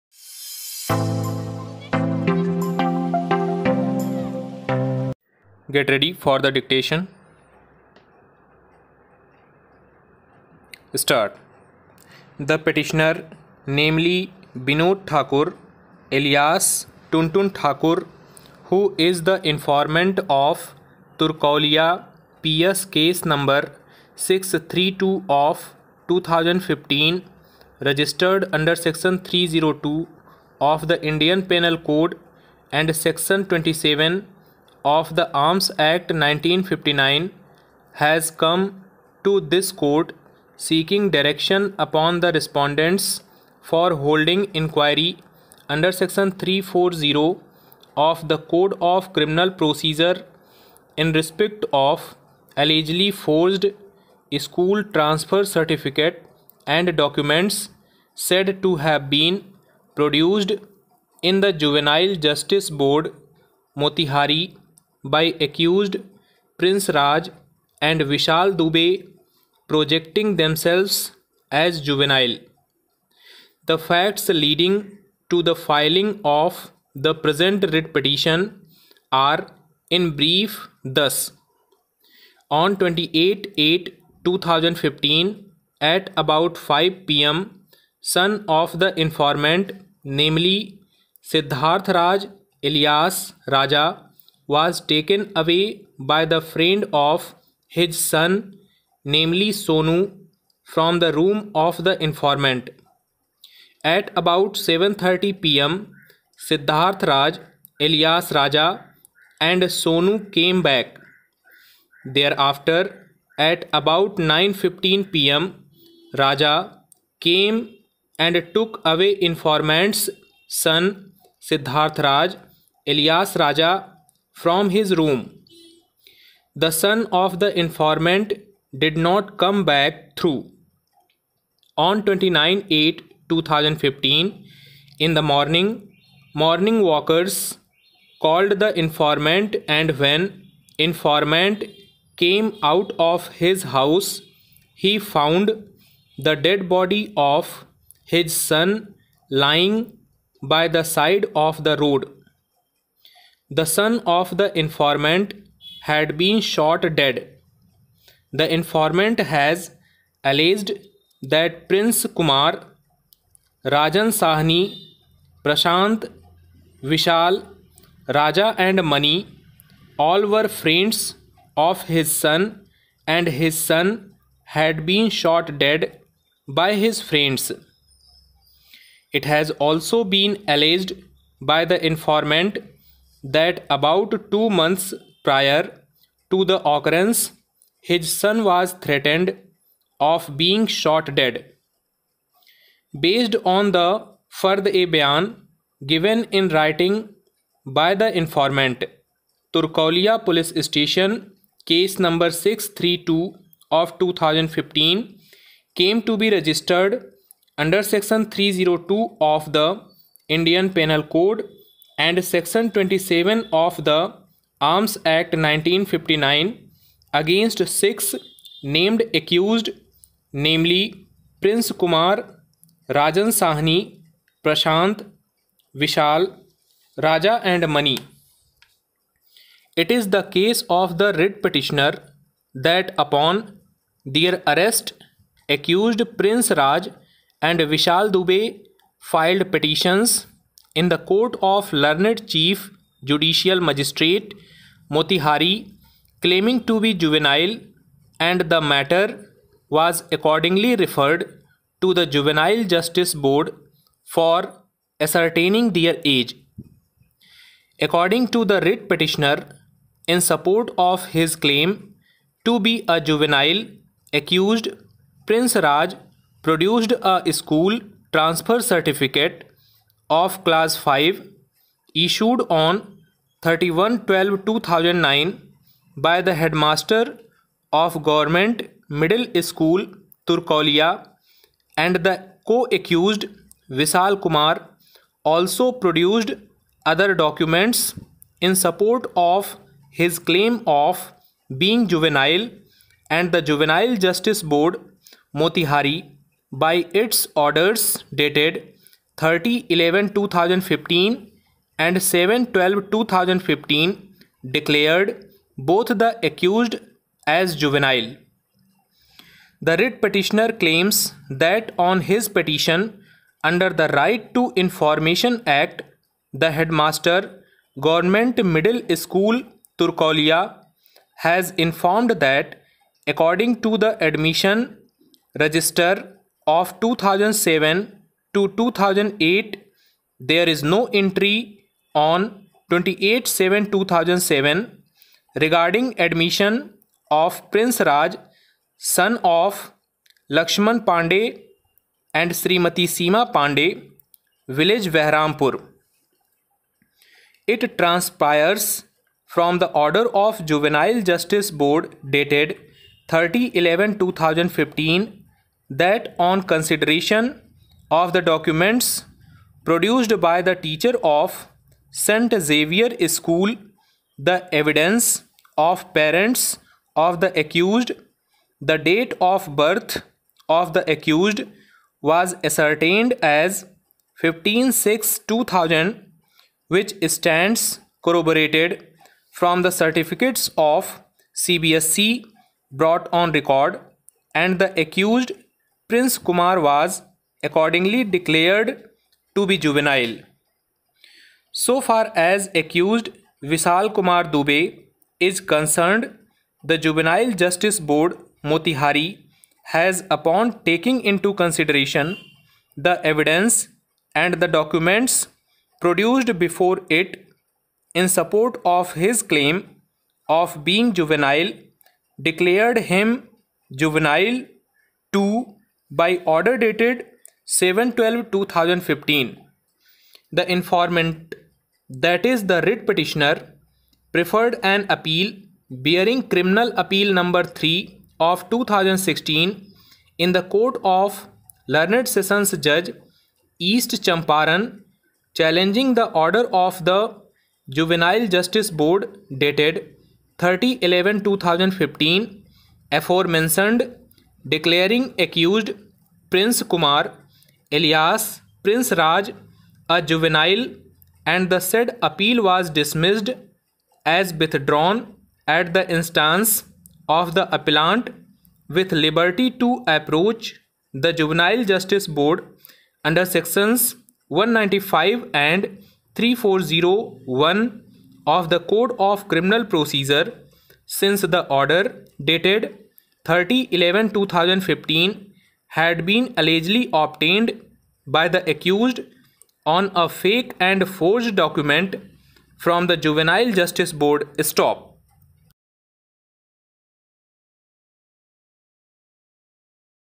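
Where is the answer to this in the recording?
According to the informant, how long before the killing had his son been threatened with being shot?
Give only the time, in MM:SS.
03:03.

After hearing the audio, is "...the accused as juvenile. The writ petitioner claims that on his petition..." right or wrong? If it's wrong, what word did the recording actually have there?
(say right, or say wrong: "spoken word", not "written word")
right.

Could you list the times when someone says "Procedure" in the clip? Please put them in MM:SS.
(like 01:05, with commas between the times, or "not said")
00:49, 07:49.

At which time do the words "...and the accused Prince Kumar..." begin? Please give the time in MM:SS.
06:24.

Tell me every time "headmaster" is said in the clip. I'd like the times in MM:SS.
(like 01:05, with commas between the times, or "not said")
04:36, 05:16.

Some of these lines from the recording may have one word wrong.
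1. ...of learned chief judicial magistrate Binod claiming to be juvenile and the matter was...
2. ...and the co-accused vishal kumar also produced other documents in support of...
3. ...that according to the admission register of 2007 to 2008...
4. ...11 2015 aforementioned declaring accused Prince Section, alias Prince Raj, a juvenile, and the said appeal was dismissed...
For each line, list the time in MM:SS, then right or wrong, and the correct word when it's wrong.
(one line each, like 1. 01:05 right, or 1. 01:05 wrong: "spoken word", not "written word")
1. 04:01 wrong: "Motihari", not "Binod"
2. 04:41 right
3. 05:22 right
4. 07:20 wrong: "Kumar", not "Section".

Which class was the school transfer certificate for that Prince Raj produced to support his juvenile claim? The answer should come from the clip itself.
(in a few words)
class 5.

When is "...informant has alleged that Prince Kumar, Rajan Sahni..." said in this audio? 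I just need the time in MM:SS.
02:38.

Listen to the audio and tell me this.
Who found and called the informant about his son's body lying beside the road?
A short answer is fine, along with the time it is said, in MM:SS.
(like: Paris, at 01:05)
Morning walkers, at 02:16.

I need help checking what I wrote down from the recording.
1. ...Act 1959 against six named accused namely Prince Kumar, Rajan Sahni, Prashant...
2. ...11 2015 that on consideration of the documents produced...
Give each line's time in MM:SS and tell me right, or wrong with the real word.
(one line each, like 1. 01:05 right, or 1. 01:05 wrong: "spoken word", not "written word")
1. 03:35 right
2. 05:53 right.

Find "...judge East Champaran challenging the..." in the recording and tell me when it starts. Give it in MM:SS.
07:12.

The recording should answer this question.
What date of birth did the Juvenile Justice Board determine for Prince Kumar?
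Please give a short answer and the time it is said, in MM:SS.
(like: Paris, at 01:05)
15-6-2000, at 06:14.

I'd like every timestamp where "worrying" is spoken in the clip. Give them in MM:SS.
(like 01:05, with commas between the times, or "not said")
not said.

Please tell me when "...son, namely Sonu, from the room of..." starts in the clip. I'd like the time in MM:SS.
01:38.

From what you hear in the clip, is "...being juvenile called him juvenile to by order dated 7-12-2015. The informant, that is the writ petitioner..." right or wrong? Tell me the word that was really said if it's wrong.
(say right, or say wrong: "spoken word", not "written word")
wrong: "declared", not "called".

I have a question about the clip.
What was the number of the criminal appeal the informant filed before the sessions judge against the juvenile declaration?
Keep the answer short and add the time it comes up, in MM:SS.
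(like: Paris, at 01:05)
3 of 2016, at 07:07.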